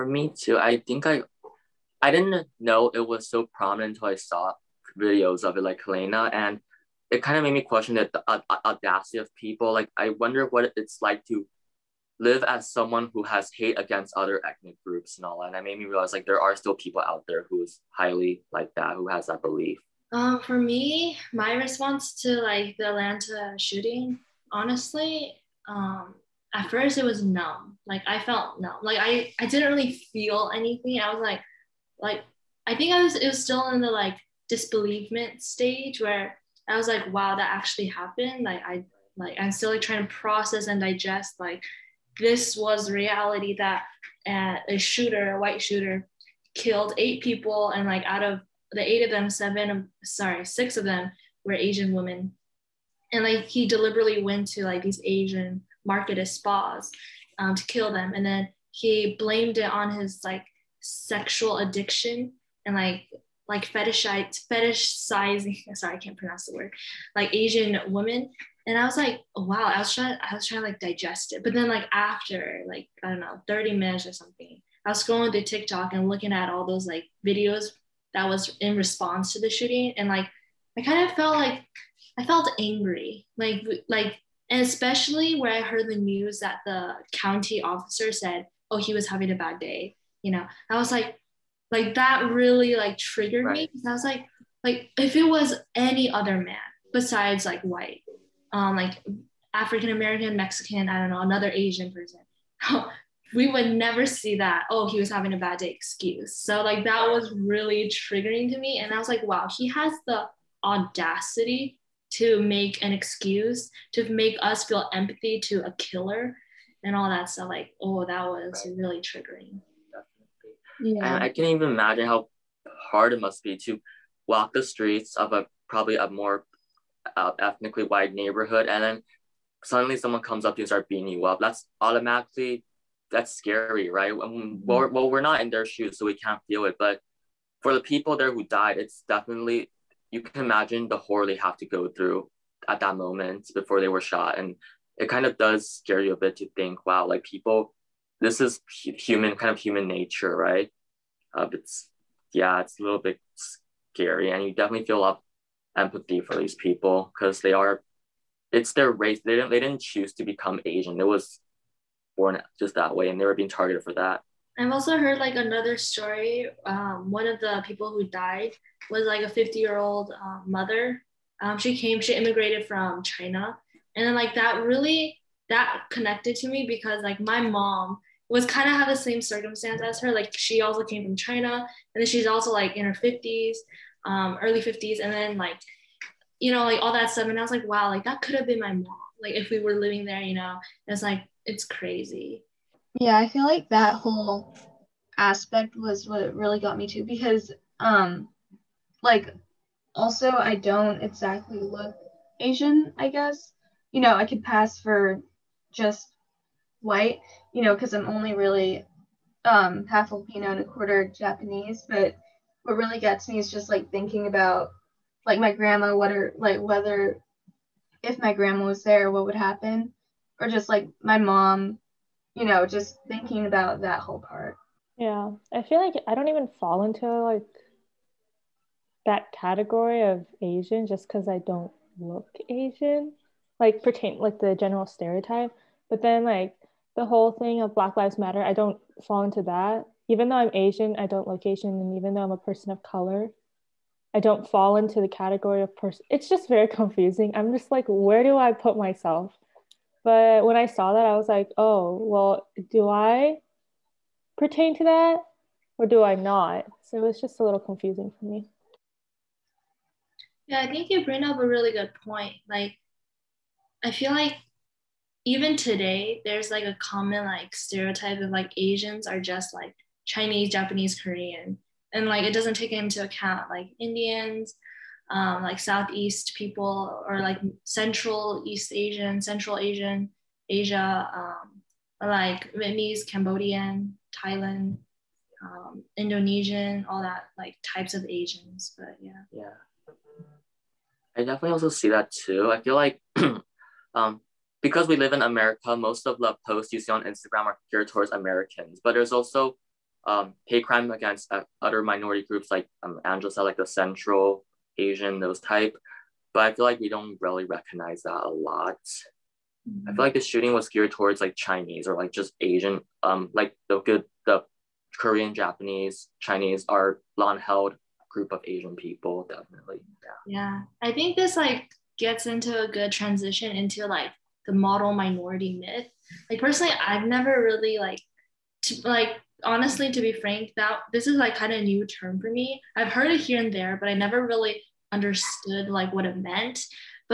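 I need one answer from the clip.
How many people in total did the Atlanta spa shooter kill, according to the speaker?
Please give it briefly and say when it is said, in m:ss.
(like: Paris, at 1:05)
8, at 0:46.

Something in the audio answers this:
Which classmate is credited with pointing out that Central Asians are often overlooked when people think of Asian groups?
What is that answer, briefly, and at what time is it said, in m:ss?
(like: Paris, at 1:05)
Angela, at 5:03.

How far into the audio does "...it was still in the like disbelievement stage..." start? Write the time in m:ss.
0:33.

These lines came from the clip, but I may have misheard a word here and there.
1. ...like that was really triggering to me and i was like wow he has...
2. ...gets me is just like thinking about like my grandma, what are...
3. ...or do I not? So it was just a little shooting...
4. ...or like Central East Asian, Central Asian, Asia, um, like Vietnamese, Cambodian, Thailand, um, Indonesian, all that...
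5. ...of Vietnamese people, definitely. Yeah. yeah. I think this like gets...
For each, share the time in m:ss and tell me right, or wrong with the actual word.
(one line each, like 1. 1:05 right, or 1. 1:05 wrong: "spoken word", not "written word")
1. 1:46 right
2. 3:33 right
3. 4:15 wrong: "confusing", not "shooting"
4. 4:37 right
5. 5:18 wrong: "Asian", not "Vietnamese".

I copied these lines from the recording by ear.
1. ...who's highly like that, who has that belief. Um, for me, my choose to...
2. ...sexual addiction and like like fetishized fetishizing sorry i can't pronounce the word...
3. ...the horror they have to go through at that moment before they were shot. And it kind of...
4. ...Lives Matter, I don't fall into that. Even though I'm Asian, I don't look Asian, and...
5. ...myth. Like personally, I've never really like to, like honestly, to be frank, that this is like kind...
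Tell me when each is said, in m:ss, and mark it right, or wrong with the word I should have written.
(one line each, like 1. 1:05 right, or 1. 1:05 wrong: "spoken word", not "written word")
1. 0:17 wrong: "response", not "choose"
2. 1:00 right
3. 2:20 right
4. 3:57 right
5. 5:25 right.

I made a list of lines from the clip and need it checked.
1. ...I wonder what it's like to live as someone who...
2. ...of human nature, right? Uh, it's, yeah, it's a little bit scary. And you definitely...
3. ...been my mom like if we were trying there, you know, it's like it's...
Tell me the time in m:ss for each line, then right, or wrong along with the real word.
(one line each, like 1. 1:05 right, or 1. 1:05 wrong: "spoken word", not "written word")
1. 0:09 right
2. 2:29 right
3. 3:08 wrong: "living", not "trying".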